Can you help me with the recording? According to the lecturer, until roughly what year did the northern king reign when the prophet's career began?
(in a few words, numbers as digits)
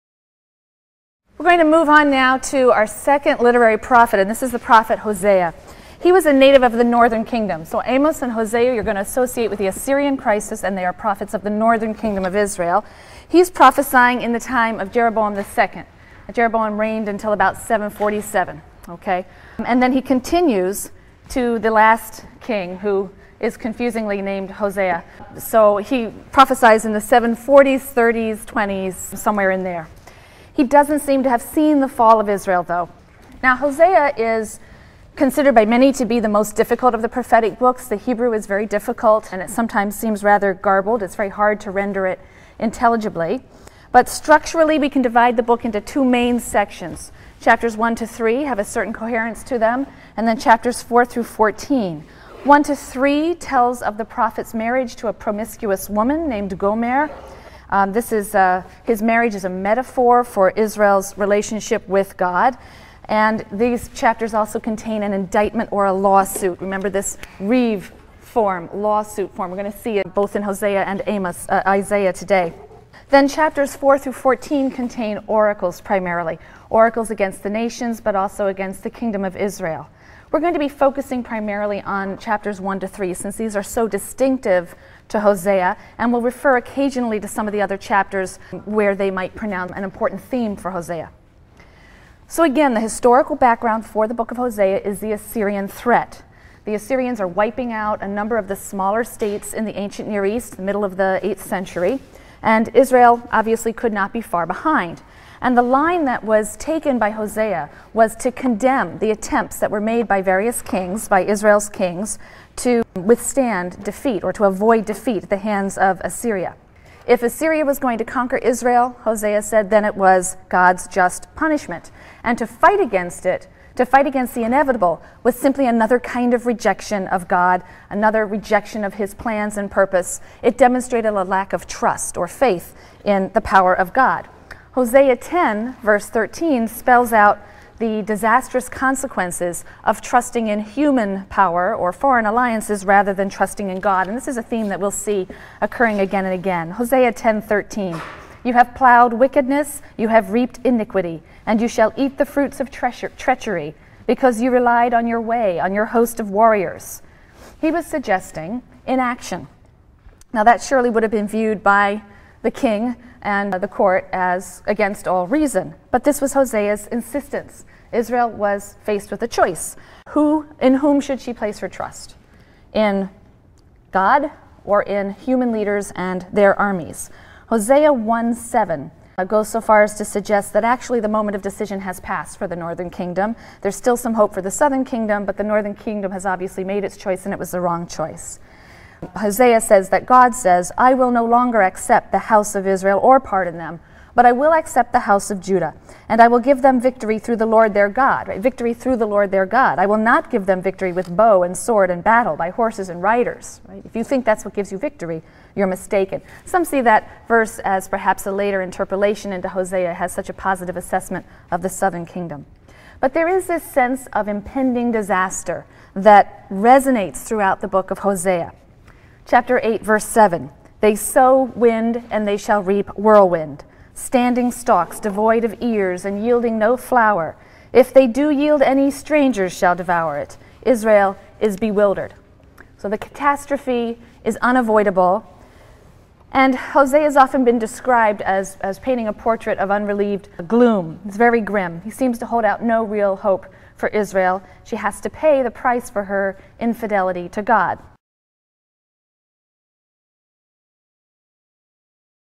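747.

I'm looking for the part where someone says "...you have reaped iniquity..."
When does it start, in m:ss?
2:29.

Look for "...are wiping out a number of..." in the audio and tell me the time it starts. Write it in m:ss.
1:37.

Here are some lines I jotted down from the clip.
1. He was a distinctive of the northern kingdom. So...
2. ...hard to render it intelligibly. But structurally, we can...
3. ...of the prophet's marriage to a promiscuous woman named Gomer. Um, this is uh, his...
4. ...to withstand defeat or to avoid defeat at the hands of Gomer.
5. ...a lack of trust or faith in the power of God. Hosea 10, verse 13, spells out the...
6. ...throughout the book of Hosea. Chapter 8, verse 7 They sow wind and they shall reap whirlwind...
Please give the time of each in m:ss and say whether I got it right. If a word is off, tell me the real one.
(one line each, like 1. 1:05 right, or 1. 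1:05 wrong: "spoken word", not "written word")
1. 0:05 wrong: "native", not "distinctive"
2. 0:41 right
3. 0:53 right
4. 1:52 wrong: "Assyria", not "Gomer"
5. 2:11 right
6. 3:37 right.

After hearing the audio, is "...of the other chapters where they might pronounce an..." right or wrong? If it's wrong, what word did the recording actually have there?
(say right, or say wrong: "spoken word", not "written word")
right.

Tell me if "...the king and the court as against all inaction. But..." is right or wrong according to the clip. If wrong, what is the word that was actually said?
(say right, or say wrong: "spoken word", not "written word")
wrong: "reason", not "inaction".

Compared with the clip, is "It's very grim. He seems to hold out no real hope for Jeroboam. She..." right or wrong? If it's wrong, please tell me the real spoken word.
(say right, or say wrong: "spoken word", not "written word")
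wrong: "Israel", not "Jeroboam".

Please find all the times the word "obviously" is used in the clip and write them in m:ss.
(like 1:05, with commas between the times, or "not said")
1:43, 3:06.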